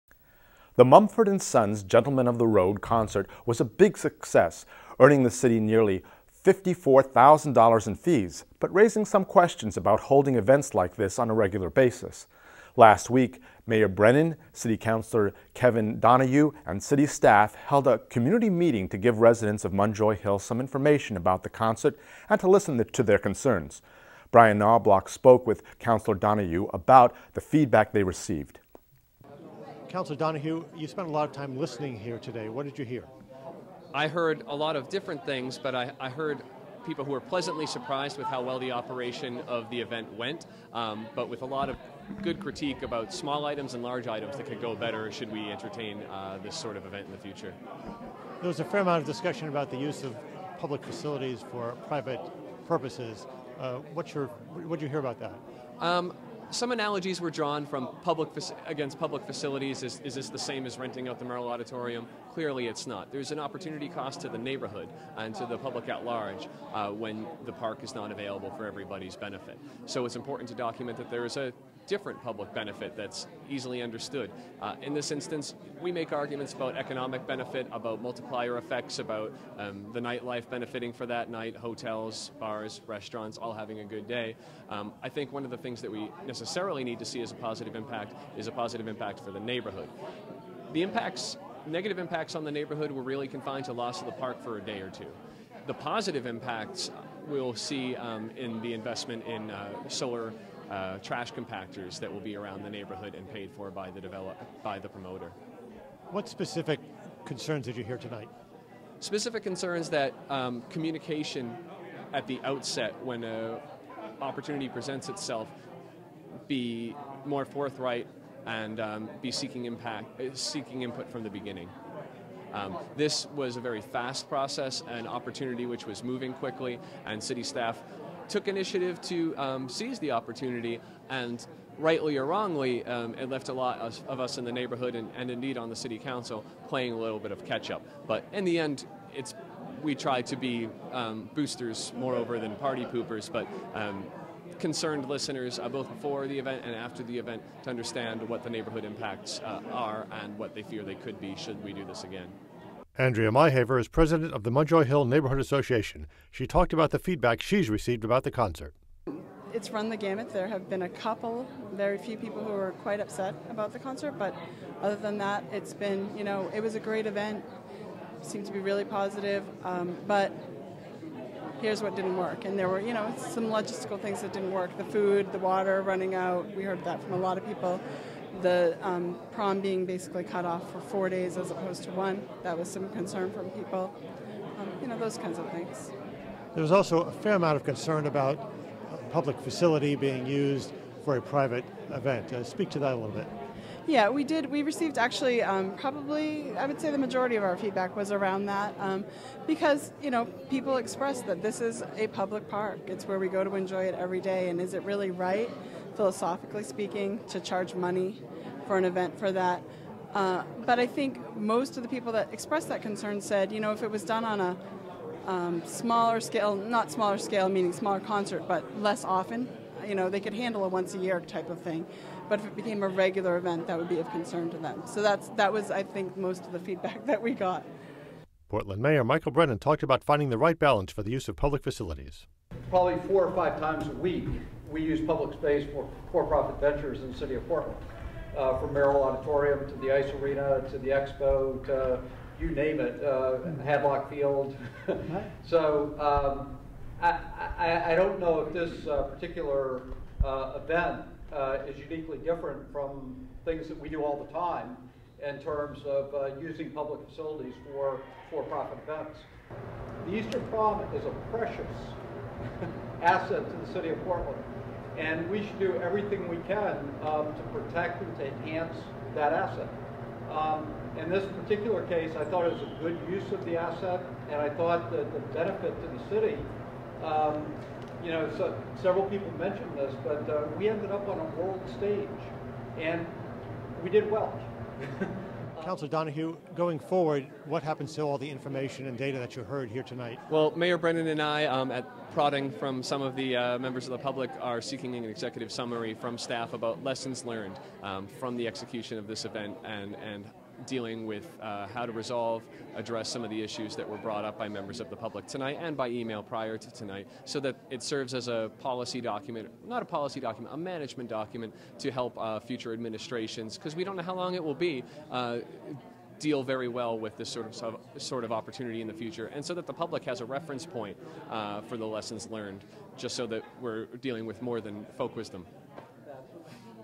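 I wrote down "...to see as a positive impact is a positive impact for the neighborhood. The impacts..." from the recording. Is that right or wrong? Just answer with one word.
right.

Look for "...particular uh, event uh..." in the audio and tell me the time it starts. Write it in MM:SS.
04:09.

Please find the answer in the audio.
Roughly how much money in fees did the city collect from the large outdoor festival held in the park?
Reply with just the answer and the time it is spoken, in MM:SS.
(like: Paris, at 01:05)
$54,000, at 00:06.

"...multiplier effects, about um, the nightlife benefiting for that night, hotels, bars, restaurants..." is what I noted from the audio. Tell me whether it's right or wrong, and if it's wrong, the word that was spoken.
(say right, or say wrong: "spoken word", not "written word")
right.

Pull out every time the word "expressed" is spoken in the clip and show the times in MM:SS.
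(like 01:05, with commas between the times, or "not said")
03:20, 03:32.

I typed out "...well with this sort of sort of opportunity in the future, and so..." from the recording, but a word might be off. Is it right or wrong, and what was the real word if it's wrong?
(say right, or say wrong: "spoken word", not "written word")
right.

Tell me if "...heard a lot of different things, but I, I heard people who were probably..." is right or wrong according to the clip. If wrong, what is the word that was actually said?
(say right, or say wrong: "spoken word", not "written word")
wrong: "pleasantly", not "probably".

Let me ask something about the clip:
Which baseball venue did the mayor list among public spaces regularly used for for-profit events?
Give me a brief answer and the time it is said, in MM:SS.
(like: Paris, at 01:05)
Hadlock Field, at 04:03.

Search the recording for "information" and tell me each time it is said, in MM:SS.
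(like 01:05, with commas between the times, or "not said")
00:20, 04:48.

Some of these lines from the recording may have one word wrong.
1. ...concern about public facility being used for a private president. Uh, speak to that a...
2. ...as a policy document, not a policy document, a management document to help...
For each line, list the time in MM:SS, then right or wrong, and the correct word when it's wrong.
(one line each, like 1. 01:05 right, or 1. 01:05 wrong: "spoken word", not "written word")
1. 03:07 wrong: "event", not "president"
2. 05:08 right.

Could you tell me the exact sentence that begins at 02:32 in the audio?
Andrea Myhaver is president of the Munjoy Hill Neighborhood Association.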